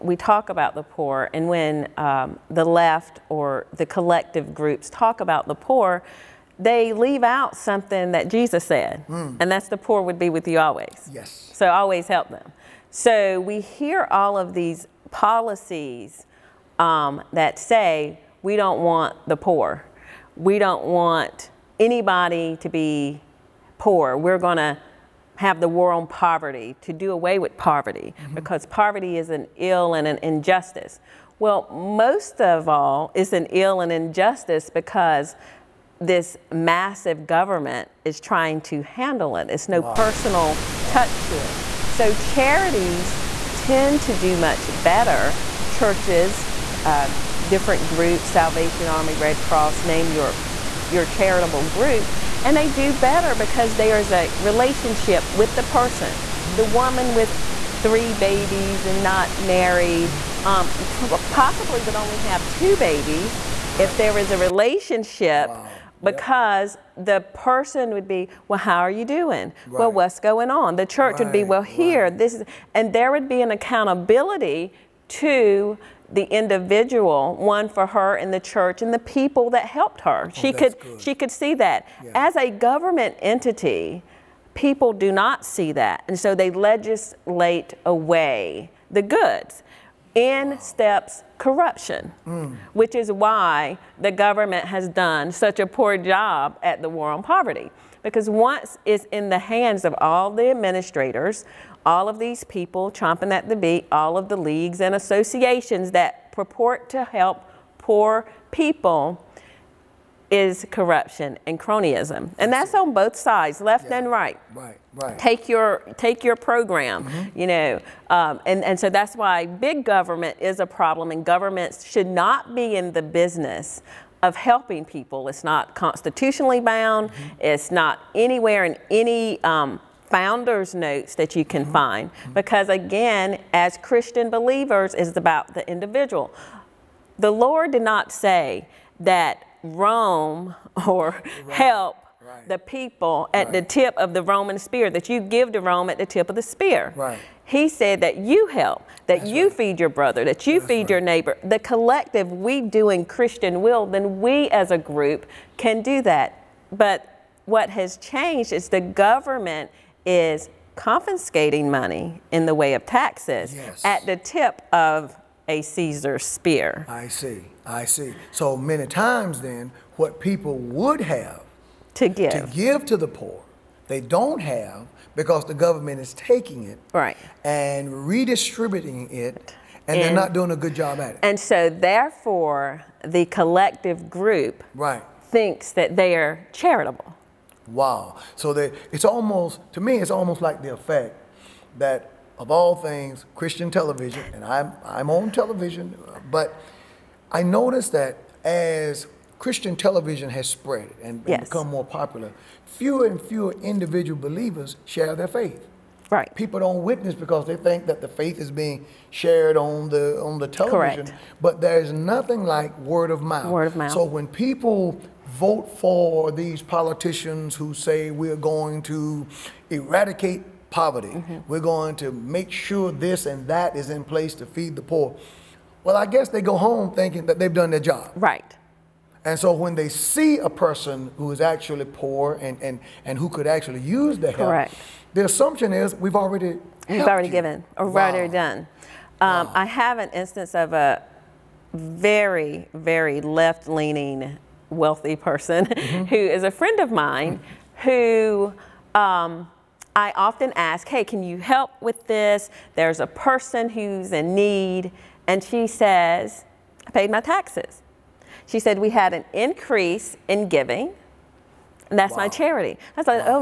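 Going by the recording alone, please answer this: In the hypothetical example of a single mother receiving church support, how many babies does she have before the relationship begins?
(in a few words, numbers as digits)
3.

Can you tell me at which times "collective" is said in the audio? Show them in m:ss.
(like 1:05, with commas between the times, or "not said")
0:03, 2:31, 3:03.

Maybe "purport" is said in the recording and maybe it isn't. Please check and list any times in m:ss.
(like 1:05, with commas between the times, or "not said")
1:46.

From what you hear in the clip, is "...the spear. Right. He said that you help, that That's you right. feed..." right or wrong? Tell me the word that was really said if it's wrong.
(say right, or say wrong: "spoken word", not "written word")
right.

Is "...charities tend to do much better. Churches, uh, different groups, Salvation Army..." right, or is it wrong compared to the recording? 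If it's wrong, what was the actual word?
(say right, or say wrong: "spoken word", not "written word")
right.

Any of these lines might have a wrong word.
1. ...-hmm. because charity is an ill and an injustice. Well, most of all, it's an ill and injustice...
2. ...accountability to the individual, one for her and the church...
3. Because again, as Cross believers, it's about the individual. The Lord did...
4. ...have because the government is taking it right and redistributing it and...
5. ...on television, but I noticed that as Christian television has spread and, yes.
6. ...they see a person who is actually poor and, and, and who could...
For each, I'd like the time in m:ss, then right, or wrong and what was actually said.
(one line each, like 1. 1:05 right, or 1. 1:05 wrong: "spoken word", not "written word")
1. 0:28 wrong: "poverty", not "charity"
2. 1:13 right
3. 2:12 wrong: "Christian", not "Cross"
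4. 2:54 right
5. 3:15 right
6. 3:49 right.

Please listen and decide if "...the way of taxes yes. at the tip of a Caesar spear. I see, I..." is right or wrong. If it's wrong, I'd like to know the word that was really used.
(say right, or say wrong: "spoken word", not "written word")
right.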